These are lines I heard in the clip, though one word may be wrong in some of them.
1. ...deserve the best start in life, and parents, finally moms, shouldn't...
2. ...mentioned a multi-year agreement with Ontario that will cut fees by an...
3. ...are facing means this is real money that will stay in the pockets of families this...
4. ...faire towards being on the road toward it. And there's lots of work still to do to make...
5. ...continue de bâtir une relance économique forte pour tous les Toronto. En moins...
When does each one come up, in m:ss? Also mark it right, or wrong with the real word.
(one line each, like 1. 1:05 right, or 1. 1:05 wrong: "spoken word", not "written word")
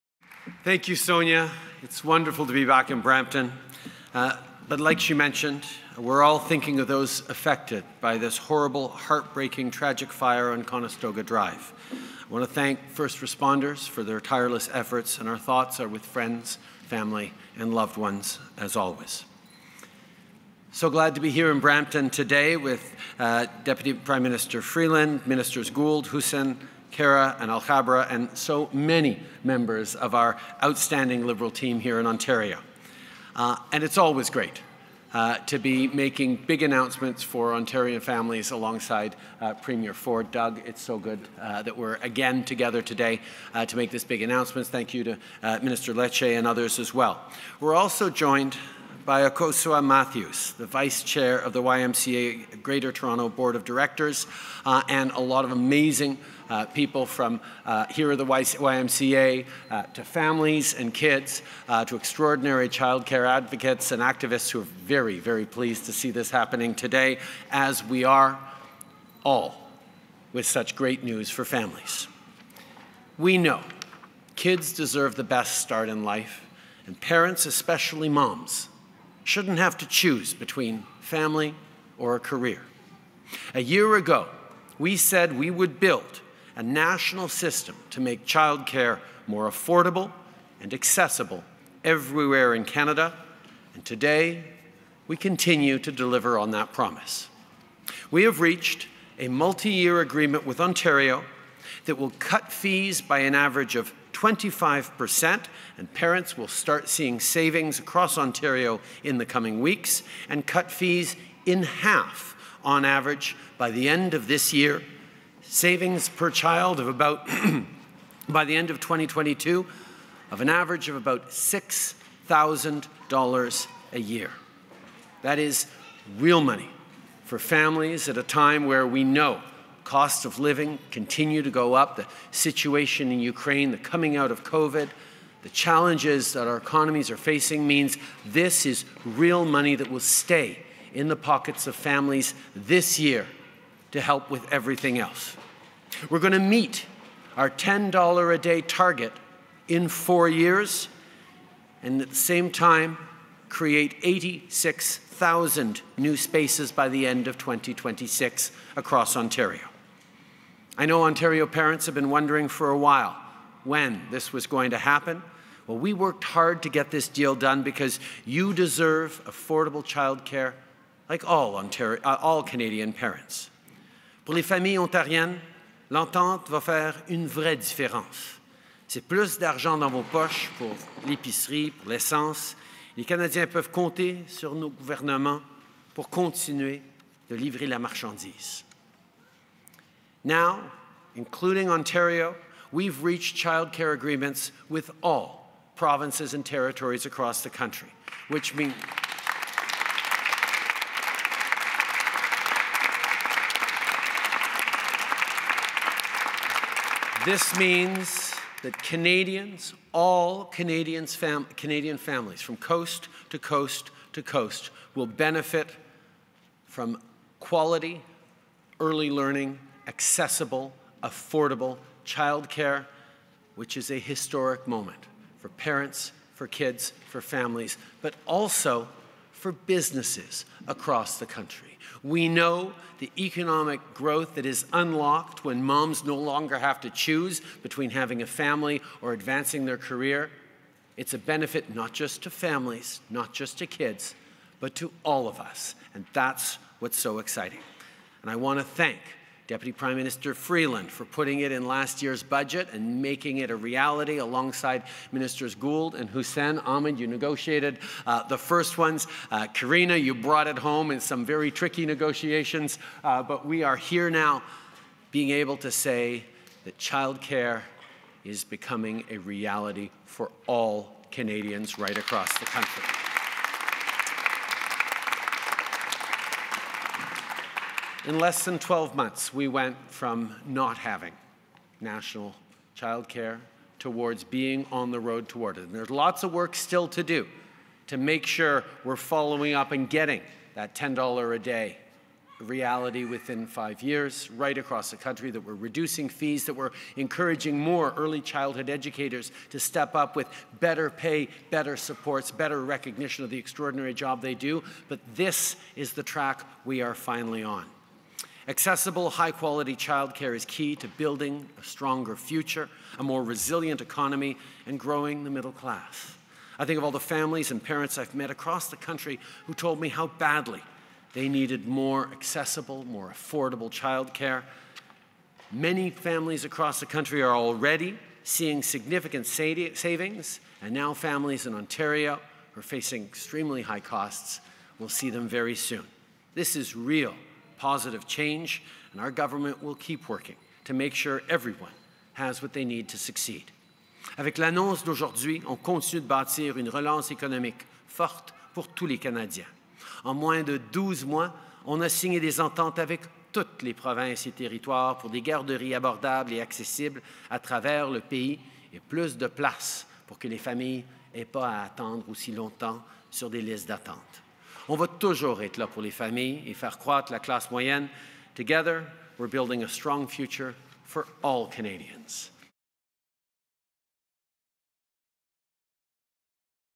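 1. 1:14 wrong: "especially", not "finally"
2. 1:38 wrong: "reached", not "mentioned"
3. 2:17 right
4. 4:42 wrong: "childcare", not "faire"
5. 5:45 wrong: "Canadiens", not "Toronto".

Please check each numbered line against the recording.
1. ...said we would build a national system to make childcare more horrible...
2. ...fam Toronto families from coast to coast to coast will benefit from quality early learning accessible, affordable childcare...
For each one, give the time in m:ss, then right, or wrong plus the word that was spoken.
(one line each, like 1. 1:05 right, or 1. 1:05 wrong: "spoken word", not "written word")
1. 1:24 wrong: "affordable", not "horrible"
2. 3:31 wrong: "Canadian", not "Toronto".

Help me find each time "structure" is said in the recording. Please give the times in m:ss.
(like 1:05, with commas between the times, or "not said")
not said.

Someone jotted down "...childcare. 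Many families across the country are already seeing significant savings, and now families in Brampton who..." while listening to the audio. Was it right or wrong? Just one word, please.
wrong.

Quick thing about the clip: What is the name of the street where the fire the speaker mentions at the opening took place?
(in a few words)
Conestoga Drive.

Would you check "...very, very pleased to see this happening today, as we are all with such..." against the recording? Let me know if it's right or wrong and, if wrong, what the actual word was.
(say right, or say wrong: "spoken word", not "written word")
right.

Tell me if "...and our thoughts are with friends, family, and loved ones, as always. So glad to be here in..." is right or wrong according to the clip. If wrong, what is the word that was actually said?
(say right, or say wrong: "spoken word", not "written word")
right.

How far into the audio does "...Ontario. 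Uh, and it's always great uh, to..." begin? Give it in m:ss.
0:32.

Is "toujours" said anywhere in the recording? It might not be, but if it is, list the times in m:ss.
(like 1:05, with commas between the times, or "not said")
6:04.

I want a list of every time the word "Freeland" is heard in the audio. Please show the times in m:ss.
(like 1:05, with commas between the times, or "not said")
0:24, 4:10.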